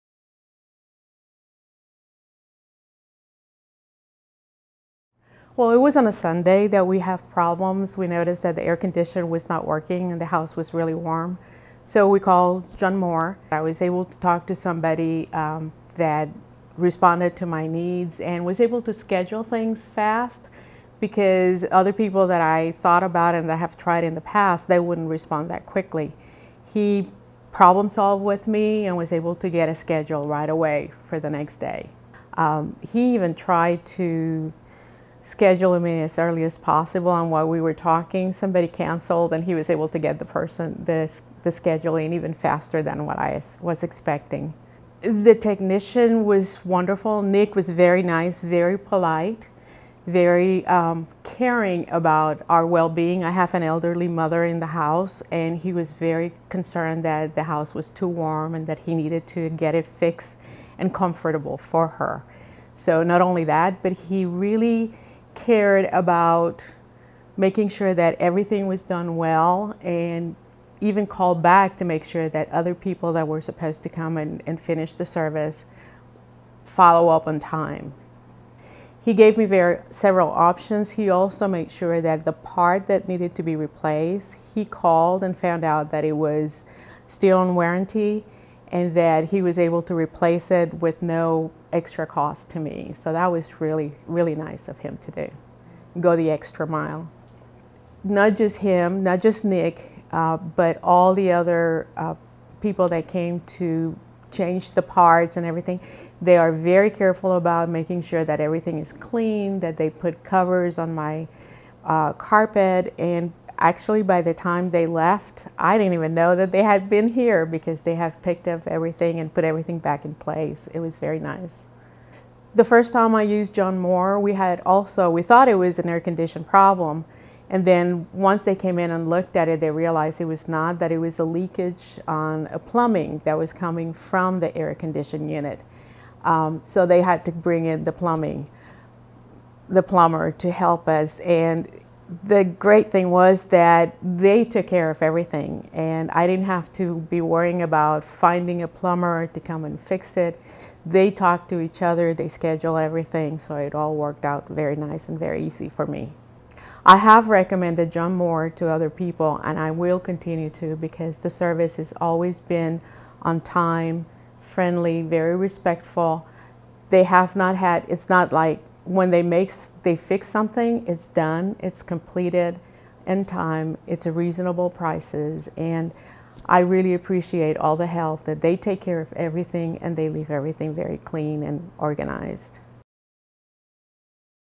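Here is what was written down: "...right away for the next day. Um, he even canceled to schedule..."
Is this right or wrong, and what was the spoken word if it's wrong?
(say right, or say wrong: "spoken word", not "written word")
wrong: "tried", not "canceled".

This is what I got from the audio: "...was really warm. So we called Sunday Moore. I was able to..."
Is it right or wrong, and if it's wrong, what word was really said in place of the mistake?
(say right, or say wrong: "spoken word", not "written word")
wrong: "John", not "Sunday".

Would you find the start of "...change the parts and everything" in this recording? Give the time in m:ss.
1:44.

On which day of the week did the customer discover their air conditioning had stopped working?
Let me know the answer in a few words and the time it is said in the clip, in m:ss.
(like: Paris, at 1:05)
Sunday, at 0:06.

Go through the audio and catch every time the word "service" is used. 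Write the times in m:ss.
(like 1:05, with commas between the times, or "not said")
1:15, 2:41.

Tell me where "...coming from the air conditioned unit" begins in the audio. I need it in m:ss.
2:13.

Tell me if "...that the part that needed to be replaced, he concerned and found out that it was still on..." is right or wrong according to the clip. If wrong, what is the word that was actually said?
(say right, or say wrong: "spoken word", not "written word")
wrong: "called", not "concerned".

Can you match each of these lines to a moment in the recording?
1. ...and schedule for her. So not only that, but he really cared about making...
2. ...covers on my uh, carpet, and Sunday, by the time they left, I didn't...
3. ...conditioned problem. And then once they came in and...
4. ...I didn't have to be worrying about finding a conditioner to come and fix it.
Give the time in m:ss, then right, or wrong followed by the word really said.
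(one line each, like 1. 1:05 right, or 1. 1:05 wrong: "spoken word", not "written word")
1. 1:00 wrong: "comfortable", not "schedule"
2. 1:50 wrong: "Actually", not "Sunday"
3. 2:05 right
4. 2:26 wrong: "plumber", not "conditioner".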